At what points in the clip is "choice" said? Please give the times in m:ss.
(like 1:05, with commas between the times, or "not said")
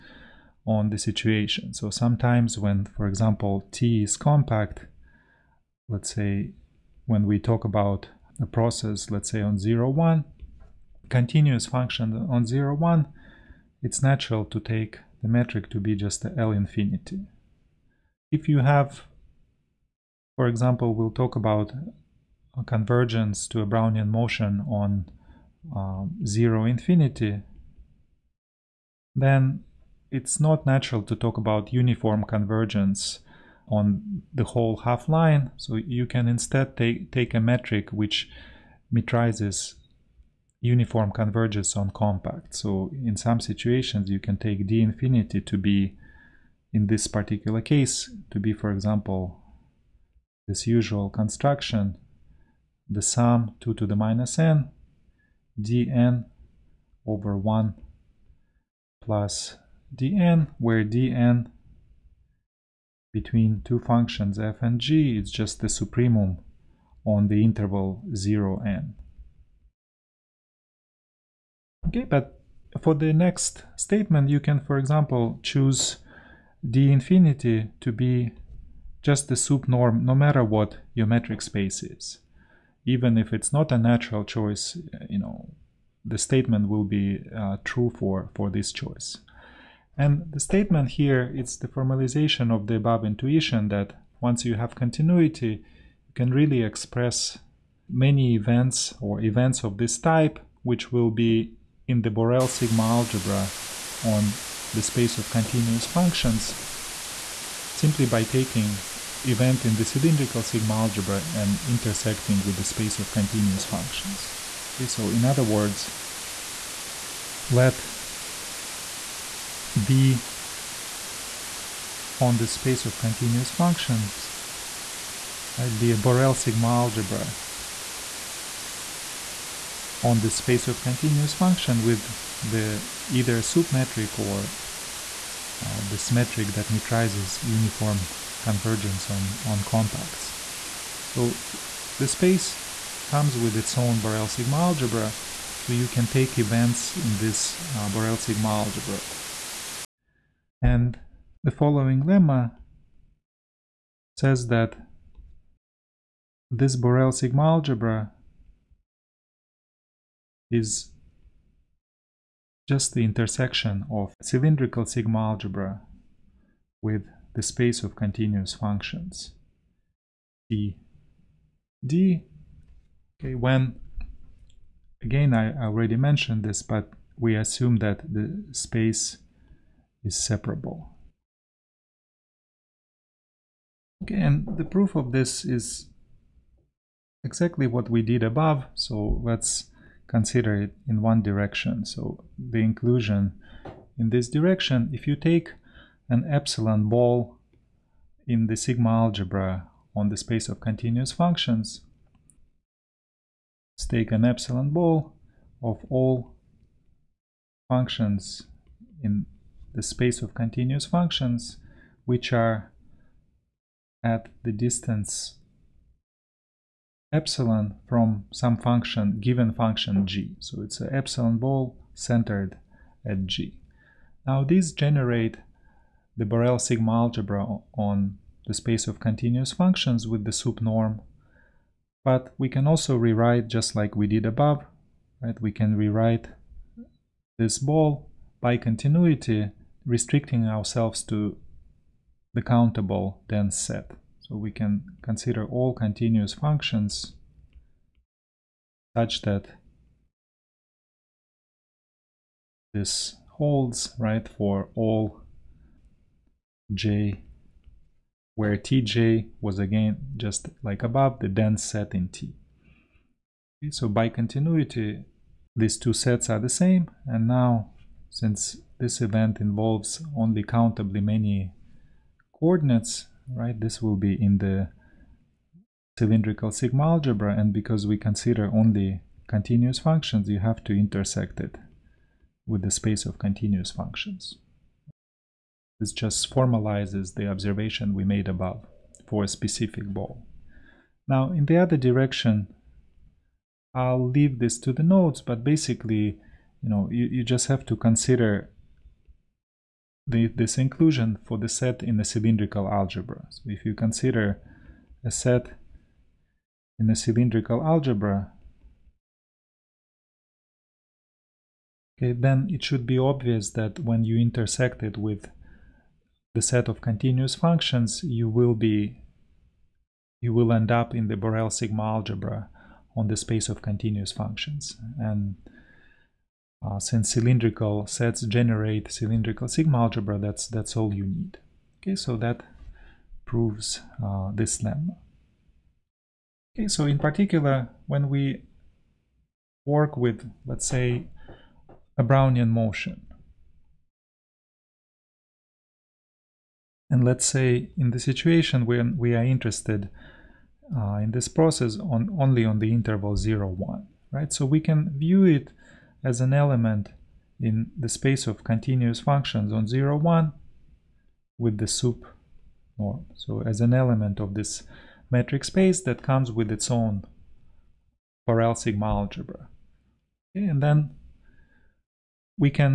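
1:24, 1:28.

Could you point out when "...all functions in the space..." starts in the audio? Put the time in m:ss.
3:25.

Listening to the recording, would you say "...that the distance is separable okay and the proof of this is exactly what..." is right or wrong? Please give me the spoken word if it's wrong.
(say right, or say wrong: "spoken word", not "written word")
wrong: "space", not "distance".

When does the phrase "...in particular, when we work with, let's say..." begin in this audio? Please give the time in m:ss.
5:36.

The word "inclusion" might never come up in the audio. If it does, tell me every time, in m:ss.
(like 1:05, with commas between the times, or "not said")
3:12, 5:00.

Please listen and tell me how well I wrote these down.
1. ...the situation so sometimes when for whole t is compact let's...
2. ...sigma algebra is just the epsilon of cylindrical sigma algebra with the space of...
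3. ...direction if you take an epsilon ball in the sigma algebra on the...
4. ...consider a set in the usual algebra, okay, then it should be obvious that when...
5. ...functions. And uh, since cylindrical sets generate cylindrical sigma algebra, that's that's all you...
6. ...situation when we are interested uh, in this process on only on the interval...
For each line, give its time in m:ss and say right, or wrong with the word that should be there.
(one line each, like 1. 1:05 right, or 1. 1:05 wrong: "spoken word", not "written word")
1. 0:00 wrong: "example", not "whole"
2. 2:37 wrong: "intersection", not "epsilon"
3. 3:14 right
4. 5:03 wrong: "cylindrical", not "usual"
5. 5:24 right
6. 5:47 right.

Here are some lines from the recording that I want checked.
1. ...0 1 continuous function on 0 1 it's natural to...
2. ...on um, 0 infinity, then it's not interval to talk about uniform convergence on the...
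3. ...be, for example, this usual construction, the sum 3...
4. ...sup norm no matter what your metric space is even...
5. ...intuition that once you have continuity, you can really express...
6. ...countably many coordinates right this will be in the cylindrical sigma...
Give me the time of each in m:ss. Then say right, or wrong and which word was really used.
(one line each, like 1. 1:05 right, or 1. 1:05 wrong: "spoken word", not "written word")
1. 0:09 right
2. 0:24 wrong: "natural", not "interval"
3. 0:48 wrong: "2", not "3"
4. 1:19 right
5. 1:33 right
6. 4:30 right.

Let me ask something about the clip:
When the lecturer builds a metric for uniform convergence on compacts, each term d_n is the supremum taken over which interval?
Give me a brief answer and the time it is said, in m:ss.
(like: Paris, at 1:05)
0 to n, at 1:07.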